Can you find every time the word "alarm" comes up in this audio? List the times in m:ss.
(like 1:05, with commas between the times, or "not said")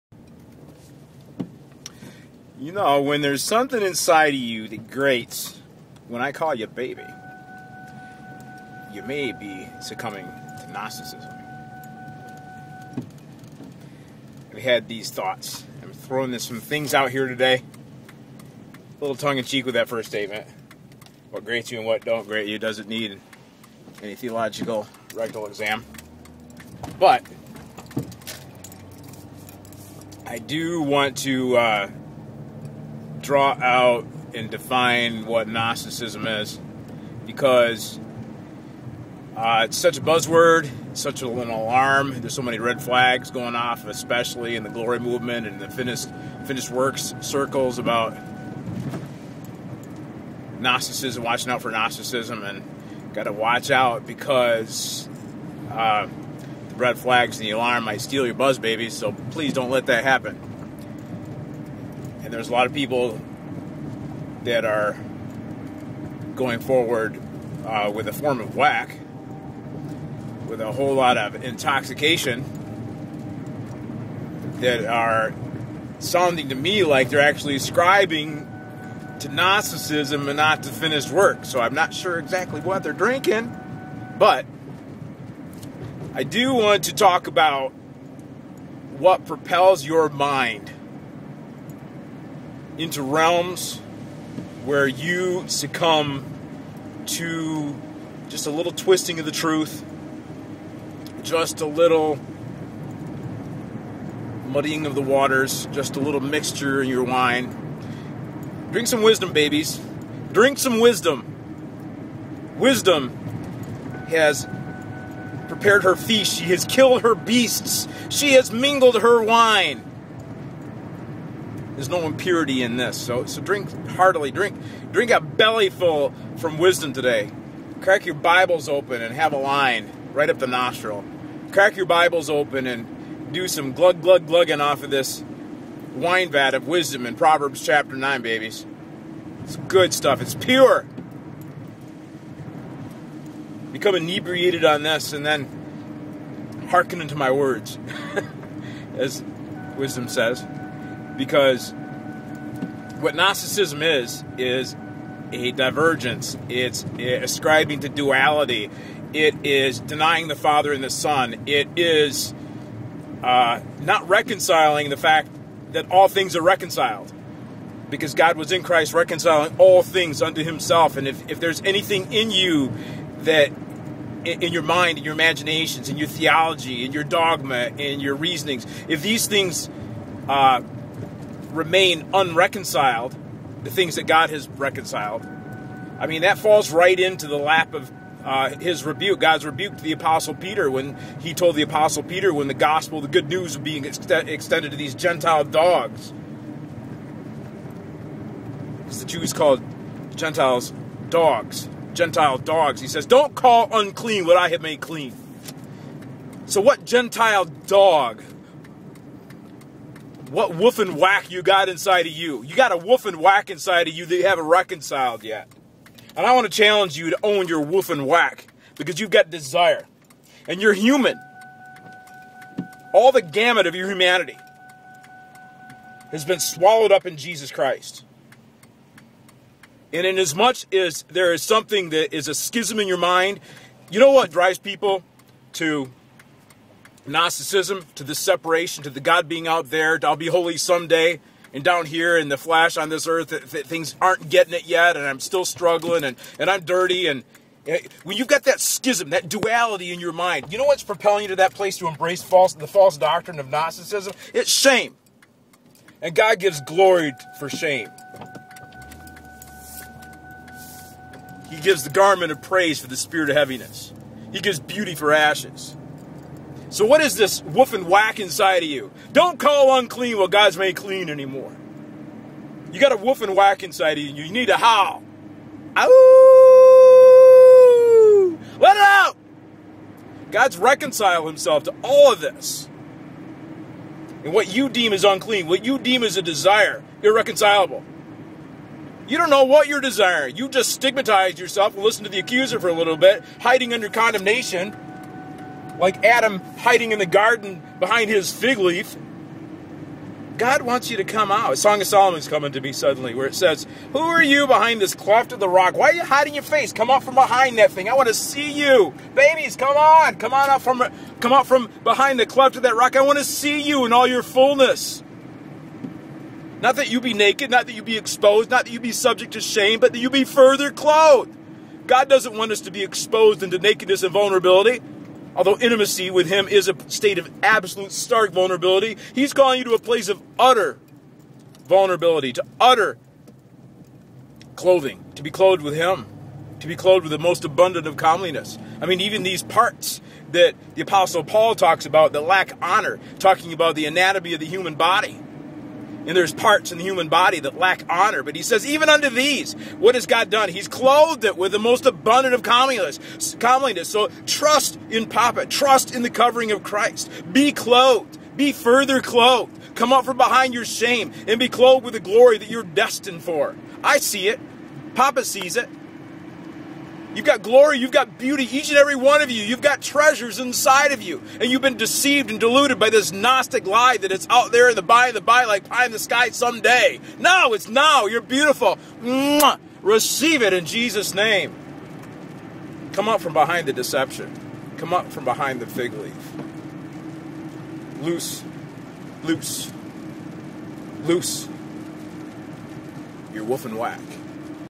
0:41, 0:57.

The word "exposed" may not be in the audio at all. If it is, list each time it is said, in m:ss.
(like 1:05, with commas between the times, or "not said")
5:17, 5:22.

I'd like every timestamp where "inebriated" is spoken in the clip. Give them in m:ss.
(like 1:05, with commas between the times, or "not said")
2:23.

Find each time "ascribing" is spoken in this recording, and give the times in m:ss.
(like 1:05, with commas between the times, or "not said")
1:17, 2:36.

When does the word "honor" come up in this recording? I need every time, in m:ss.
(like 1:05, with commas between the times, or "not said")
5:42, 5:47.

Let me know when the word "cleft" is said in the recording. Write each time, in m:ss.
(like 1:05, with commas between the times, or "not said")
5:04, 5:12.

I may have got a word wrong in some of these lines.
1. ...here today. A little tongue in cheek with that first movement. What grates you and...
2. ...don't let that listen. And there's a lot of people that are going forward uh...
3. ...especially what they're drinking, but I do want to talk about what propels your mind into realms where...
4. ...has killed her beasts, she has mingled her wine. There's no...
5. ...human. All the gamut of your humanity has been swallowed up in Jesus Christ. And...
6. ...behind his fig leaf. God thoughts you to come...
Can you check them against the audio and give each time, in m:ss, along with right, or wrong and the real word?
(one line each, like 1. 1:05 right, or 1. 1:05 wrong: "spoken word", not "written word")
1. 0:17 wrong: "statement", not "movement"
2. 0:59 wrong: "happen", not "listen"
3. 1:22 wrong: "exactly", not "especially"
4. 1:56 right
5. 3:40 right
6. 4:57 wrong: "wants", not "thoughts".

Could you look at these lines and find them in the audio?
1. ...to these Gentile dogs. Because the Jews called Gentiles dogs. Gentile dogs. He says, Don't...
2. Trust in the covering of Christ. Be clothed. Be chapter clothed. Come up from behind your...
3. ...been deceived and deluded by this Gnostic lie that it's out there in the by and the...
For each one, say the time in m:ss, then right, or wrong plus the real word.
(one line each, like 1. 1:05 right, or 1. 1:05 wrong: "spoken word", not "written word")
1. 3:14 right
2. 5:55 wrong: "further", not "chapter"
3. 6:11 right.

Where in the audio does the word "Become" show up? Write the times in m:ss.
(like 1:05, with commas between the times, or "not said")
2:23.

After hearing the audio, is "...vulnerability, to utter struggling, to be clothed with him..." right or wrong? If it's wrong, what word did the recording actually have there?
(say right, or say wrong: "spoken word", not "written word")
wrong: "clothing", not "struggling".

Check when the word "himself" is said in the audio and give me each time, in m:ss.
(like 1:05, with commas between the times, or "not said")
2:50, 4:41.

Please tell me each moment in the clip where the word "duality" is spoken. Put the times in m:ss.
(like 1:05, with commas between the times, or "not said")
2:37, 4:09.